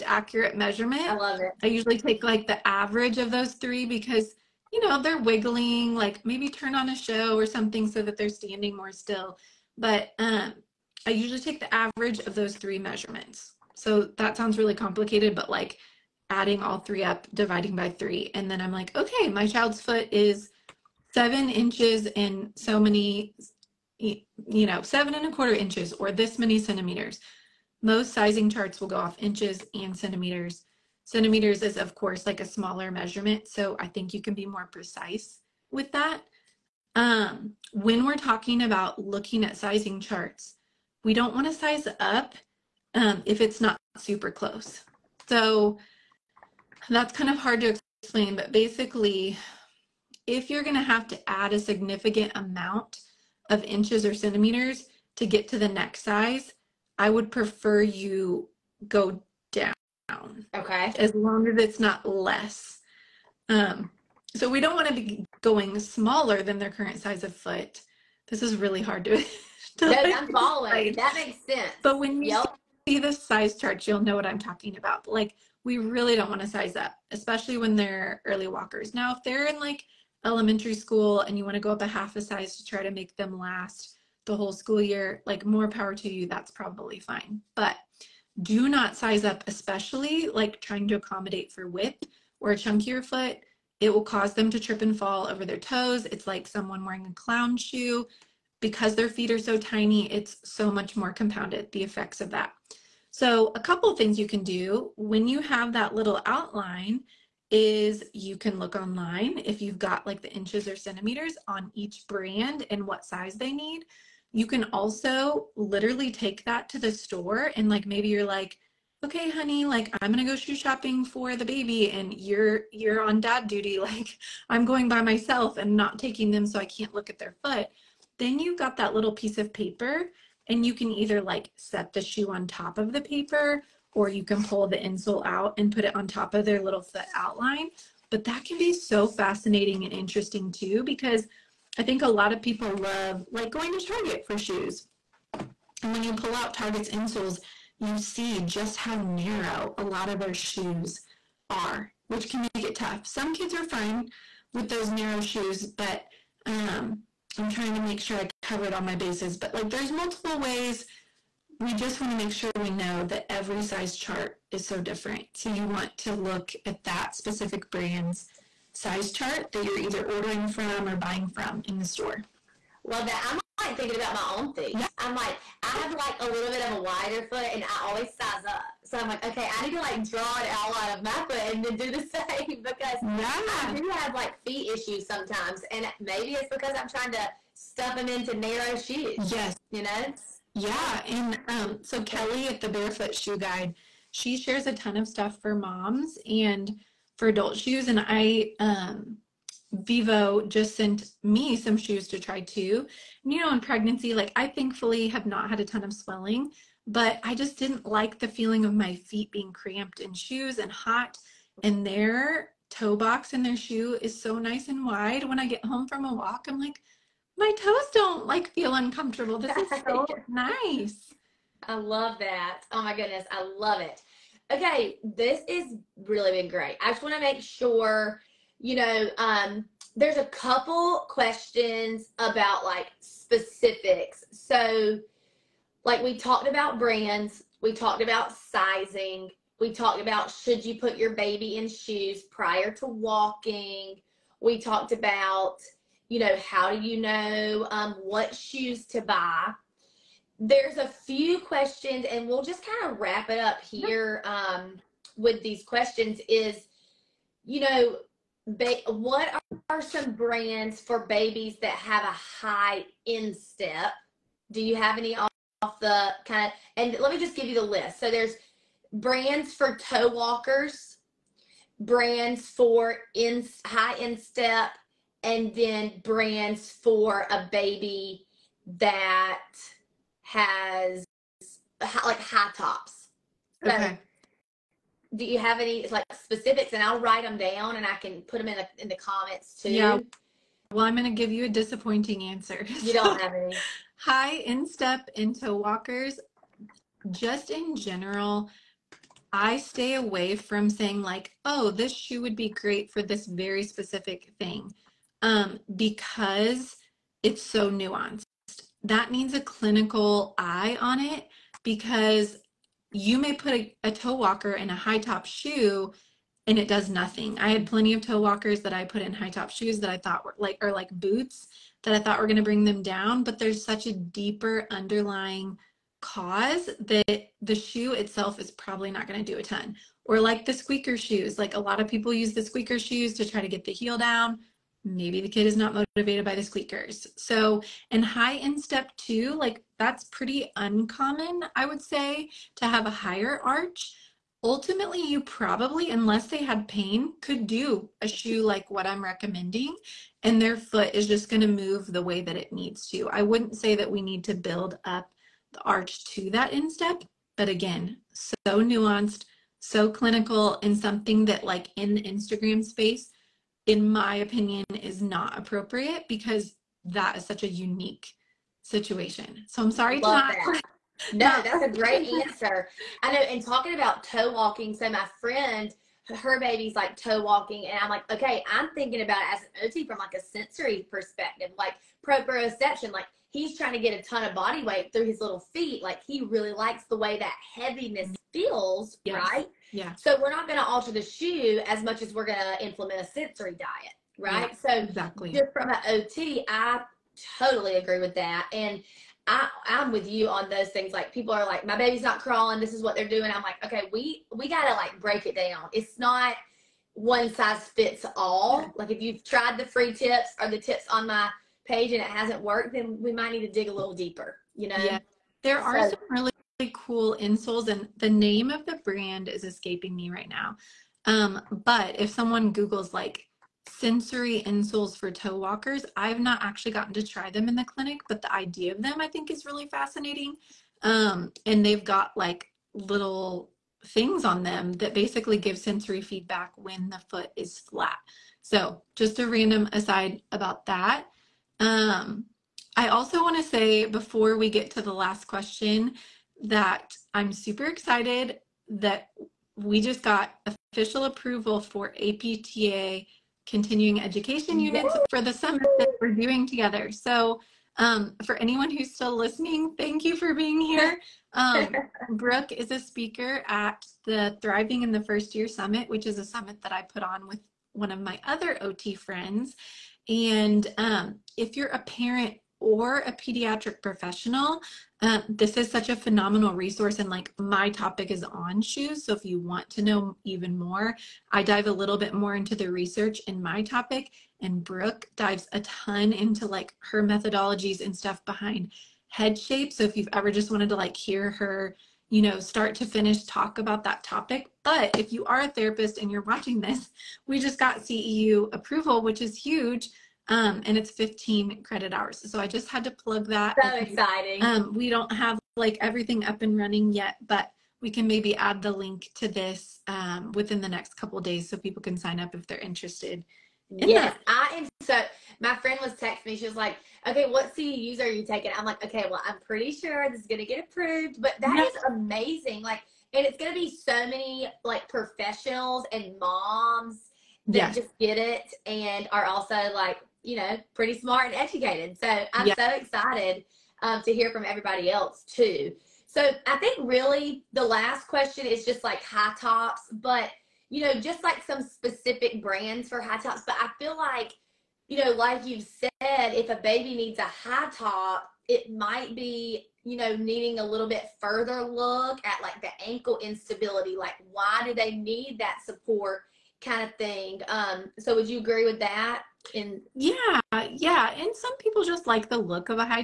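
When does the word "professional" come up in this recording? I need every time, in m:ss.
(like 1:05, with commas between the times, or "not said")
7:53, 8:44.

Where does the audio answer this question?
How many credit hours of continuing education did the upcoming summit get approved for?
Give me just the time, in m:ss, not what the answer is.
8:20.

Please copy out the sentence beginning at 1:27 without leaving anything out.
But do not size up, especially like trying to accommodate for width or a chunkier foot.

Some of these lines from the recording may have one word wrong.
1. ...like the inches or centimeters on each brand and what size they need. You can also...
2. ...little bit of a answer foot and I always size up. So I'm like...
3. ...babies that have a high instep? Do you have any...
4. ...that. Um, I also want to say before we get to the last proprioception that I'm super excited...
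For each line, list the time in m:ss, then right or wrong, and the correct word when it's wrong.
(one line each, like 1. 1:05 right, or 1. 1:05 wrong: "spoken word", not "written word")
1. 1:50 right
2. 2:56 wrong: "wider", not "answer"
3. 4:21 right
4. 7:20 wrong: "question", not "proprioception".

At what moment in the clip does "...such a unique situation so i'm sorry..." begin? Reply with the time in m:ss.
6:07.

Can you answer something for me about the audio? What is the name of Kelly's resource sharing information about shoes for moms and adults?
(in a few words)
the Barefoot Shoe Guide.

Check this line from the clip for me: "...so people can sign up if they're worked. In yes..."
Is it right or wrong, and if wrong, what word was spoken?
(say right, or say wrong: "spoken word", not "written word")
wrong: "interested", not "worked".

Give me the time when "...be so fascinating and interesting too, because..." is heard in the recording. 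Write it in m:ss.
2:18.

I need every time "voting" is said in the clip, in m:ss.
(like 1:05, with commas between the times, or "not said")
not said.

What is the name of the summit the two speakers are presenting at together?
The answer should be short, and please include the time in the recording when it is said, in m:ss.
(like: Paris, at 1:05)
Thriving in the First Year Summit, at 7:44.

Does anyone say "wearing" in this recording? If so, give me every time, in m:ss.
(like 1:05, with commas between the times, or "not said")
1:36.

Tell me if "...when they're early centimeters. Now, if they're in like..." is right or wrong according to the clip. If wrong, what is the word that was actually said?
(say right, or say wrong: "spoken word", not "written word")
wrong: "walkers", not "centimeters".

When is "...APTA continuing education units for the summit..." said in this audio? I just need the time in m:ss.
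7:31.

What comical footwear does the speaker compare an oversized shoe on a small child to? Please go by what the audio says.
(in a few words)
a clown shoe.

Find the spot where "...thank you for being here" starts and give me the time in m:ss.
7:39.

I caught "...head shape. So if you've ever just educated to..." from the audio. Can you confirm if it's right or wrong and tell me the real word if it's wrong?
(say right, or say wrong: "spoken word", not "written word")
wrong: "wanted", not "educated".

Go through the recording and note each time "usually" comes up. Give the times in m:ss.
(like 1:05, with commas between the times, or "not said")
0:01, 0:11.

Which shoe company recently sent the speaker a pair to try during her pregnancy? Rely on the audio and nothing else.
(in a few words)
Vivo.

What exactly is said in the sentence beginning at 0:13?
So that sounds really complicated, but like adding all three up, dividing by three.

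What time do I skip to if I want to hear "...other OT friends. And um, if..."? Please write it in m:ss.
7:48.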